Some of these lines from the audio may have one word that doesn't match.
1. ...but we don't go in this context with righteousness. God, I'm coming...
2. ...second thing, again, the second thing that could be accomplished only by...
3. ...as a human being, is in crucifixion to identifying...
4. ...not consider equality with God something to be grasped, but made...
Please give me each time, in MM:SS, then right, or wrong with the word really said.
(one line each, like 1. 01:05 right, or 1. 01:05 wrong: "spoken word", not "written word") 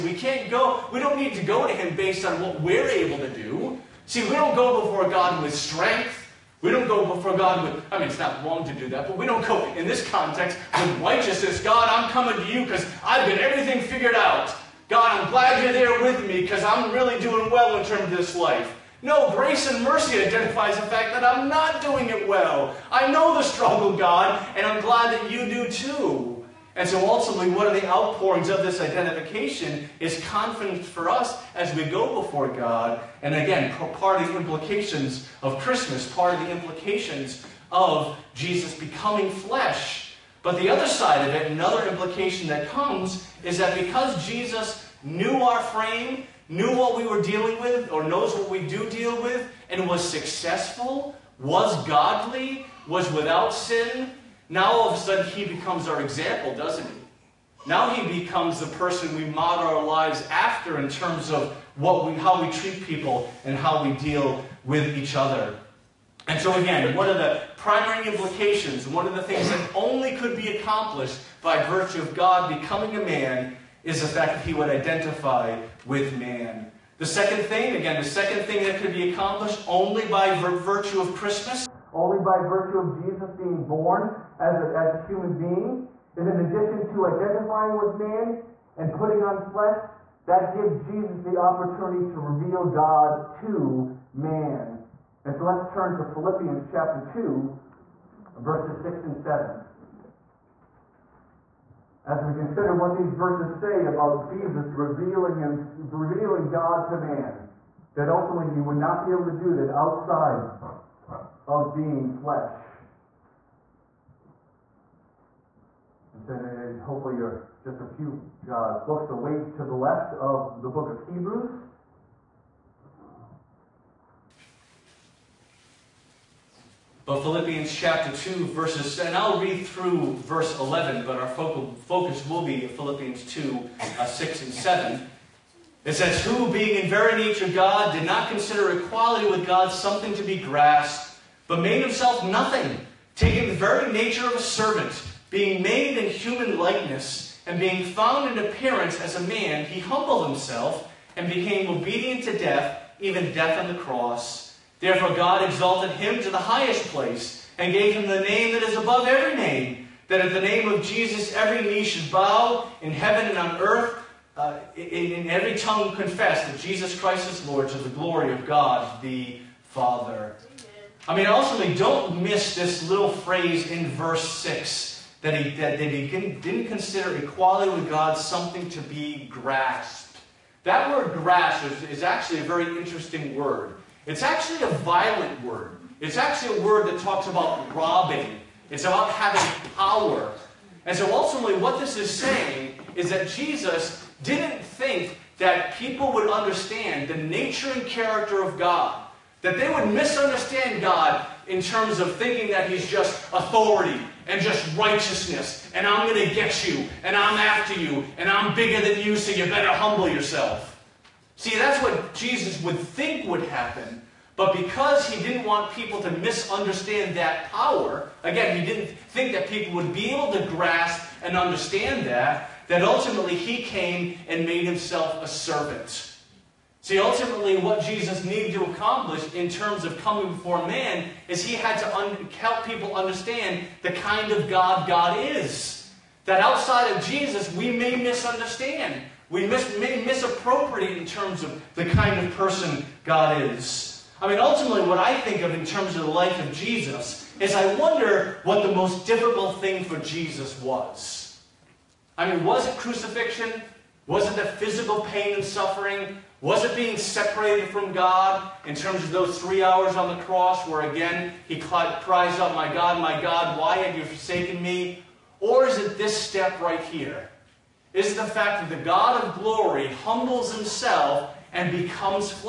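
1. 00:09 right
2. 01:17 right
3. 01:24 wrong: "addition", not "crucifixion"
4. 02:18 right.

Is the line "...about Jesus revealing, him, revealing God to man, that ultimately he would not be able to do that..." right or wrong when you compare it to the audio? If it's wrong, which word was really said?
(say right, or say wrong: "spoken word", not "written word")
right.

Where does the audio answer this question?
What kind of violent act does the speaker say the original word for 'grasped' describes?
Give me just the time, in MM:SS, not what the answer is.
03:07.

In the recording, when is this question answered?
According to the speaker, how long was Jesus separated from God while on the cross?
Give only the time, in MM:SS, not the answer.
04:19.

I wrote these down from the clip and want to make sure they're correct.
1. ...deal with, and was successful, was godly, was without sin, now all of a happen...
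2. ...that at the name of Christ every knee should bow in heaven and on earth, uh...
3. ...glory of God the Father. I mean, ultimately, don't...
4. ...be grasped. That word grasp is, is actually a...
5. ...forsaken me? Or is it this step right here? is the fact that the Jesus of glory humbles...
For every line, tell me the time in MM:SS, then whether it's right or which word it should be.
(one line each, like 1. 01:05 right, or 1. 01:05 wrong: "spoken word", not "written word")
1. 00:48 wrong: "sudden", not "happen"
2. 02:40 wrong: "Jesus", not "Christ"
3. 02:47 right
4. 02:58 right
5. 04:24 wrong: "God", not "Jesus".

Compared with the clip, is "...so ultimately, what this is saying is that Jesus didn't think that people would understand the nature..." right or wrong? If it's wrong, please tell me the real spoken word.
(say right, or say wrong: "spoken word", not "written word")
right.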